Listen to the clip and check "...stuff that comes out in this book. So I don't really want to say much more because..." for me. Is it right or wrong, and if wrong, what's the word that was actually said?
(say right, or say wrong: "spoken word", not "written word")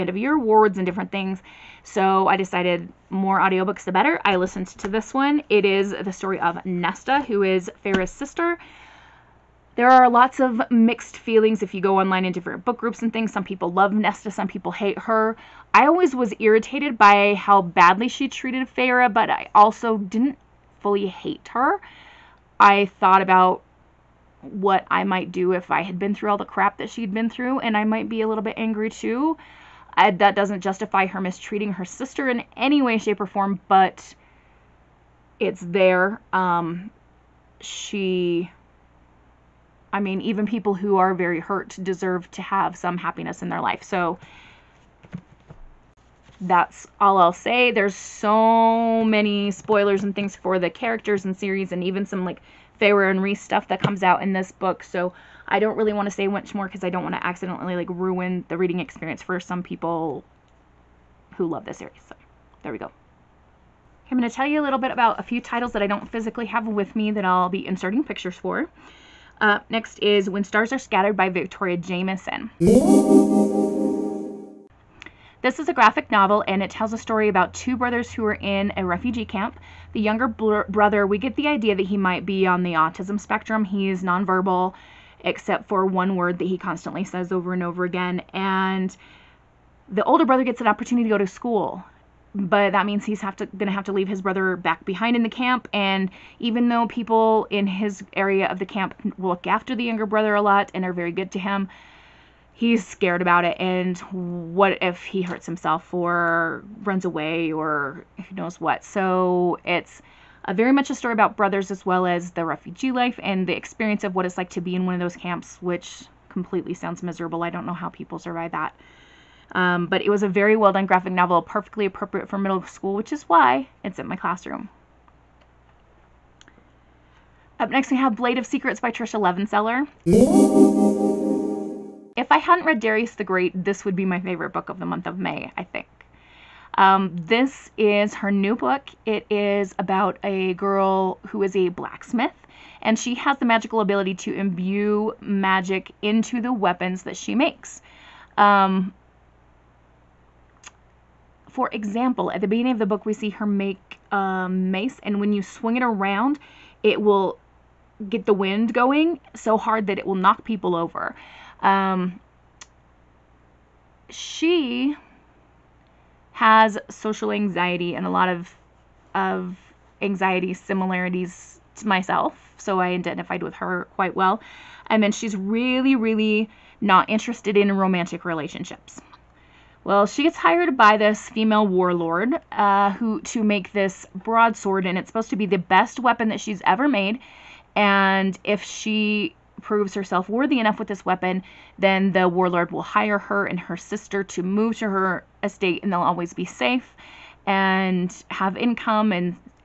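right.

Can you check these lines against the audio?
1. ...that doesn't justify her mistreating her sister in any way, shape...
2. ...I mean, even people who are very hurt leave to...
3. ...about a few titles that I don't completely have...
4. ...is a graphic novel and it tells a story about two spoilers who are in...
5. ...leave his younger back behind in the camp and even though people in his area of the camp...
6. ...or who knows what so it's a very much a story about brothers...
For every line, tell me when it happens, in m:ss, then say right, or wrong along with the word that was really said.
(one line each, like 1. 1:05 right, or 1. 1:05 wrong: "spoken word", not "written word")
1. 0:30 right
2. 0:39 wrong: "deserve", not "leave"
3. 1:04 wrong: "physically", not "completely"
4. 1:15 wrong: "brothers", not "spoilers"
5. 1:33 wrong: "brother", not "younger"
6. 1:47 right.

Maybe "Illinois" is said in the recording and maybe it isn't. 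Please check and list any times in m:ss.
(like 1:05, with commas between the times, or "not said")
not said.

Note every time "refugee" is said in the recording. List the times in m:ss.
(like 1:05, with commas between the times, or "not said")
1:18, 1:52.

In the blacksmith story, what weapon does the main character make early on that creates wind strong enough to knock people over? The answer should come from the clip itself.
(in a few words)
a mace.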